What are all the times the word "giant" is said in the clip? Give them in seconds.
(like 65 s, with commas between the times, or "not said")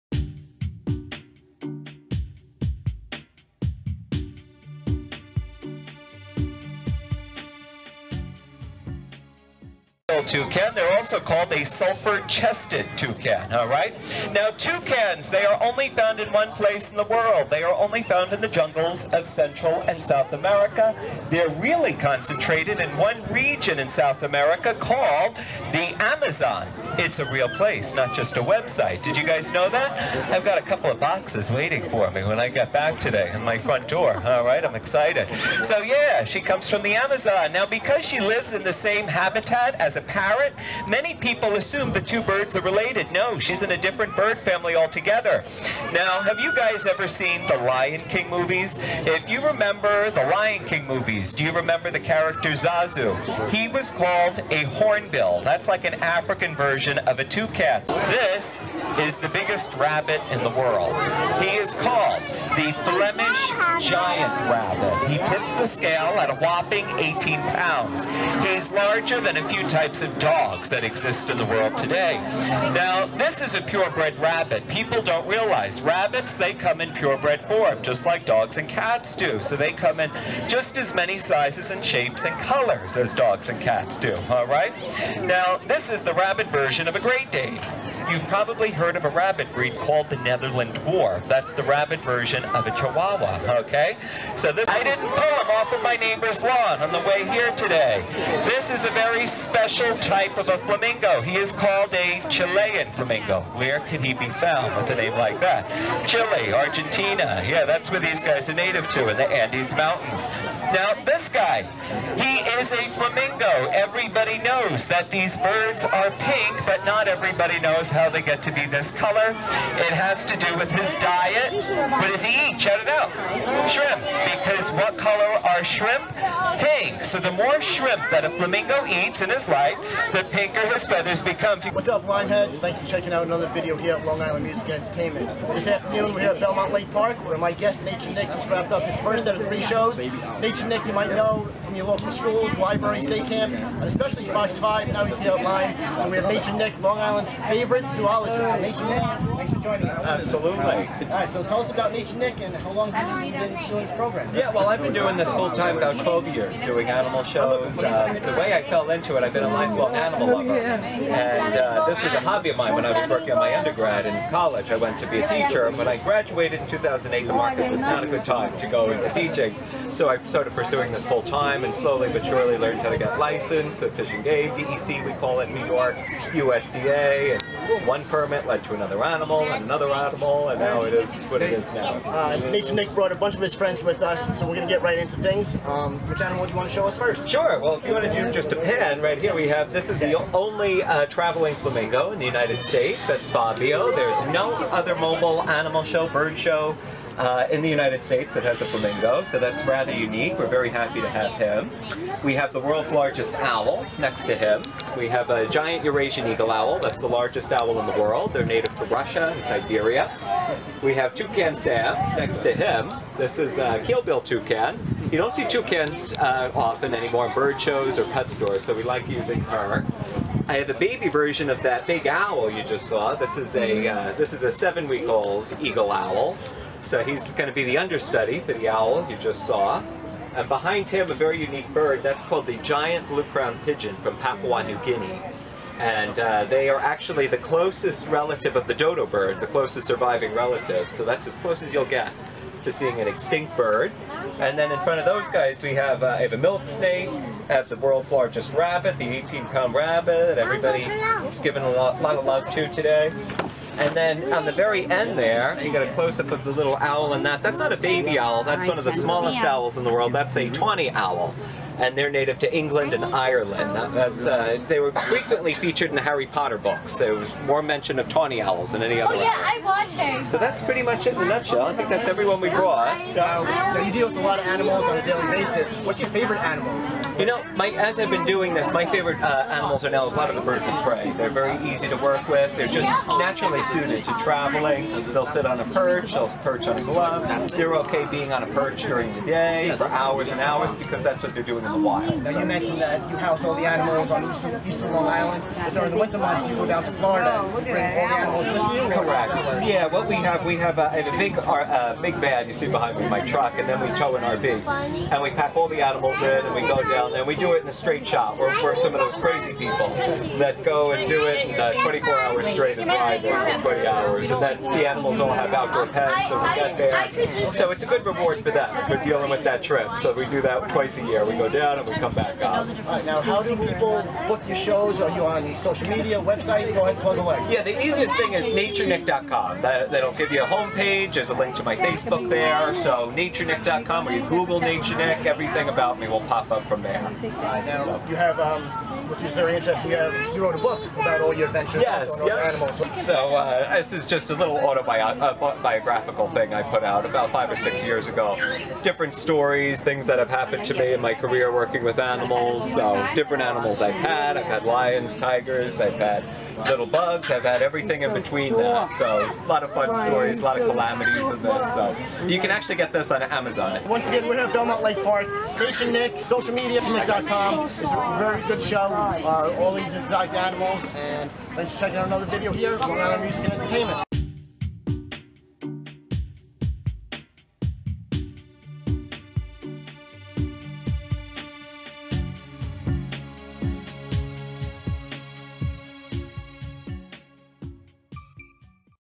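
63 s, 205 s, 232 s.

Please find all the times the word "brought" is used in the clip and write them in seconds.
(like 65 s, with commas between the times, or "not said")
182 s, 272 s.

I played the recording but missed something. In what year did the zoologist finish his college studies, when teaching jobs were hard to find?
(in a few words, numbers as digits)
2008.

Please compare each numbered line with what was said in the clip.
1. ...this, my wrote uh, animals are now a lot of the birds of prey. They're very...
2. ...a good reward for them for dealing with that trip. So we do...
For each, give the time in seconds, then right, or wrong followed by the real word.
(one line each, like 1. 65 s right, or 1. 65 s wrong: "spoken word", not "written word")
1. 278 s wrong: "favorite", not "wrote"
2. 317 s right.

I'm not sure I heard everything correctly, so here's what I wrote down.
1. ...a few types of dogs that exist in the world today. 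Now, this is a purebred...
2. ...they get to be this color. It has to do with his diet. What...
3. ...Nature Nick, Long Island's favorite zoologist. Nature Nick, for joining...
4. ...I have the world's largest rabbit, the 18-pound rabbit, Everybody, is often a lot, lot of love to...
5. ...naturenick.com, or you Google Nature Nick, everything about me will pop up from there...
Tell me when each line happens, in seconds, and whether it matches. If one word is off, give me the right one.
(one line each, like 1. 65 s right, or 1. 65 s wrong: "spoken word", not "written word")
1. 69 s right
2. 118 s right
3. 146 s right
4. 247 s wrong: "given", not "often"
5. 333 s right.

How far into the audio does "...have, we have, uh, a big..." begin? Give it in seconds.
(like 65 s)
300 s.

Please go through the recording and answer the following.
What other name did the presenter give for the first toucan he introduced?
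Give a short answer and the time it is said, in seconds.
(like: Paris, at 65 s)
Sulfur-chested toucan, at 11 s.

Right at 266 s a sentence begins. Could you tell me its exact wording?
There was more mention of tawny owls than any other.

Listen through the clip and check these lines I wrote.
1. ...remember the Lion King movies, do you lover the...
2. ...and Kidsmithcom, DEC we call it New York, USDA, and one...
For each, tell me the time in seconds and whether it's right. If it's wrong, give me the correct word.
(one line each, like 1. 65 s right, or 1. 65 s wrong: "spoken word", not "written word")
1. 49 s wrong: "remember", not "lover"
2. 174 s wrong: "Game", not "Kidsmithcom".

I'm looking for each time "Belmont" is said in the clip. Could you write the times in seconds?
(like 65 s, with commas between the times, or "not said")
136 s, 364 s.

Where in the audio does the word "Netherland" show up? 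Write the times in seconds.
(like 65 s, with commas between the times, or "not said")
90 s.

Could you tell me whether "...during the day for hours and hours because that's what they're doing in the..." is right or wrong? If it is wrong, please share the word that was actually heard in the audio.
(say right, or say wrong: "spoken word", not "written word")
right.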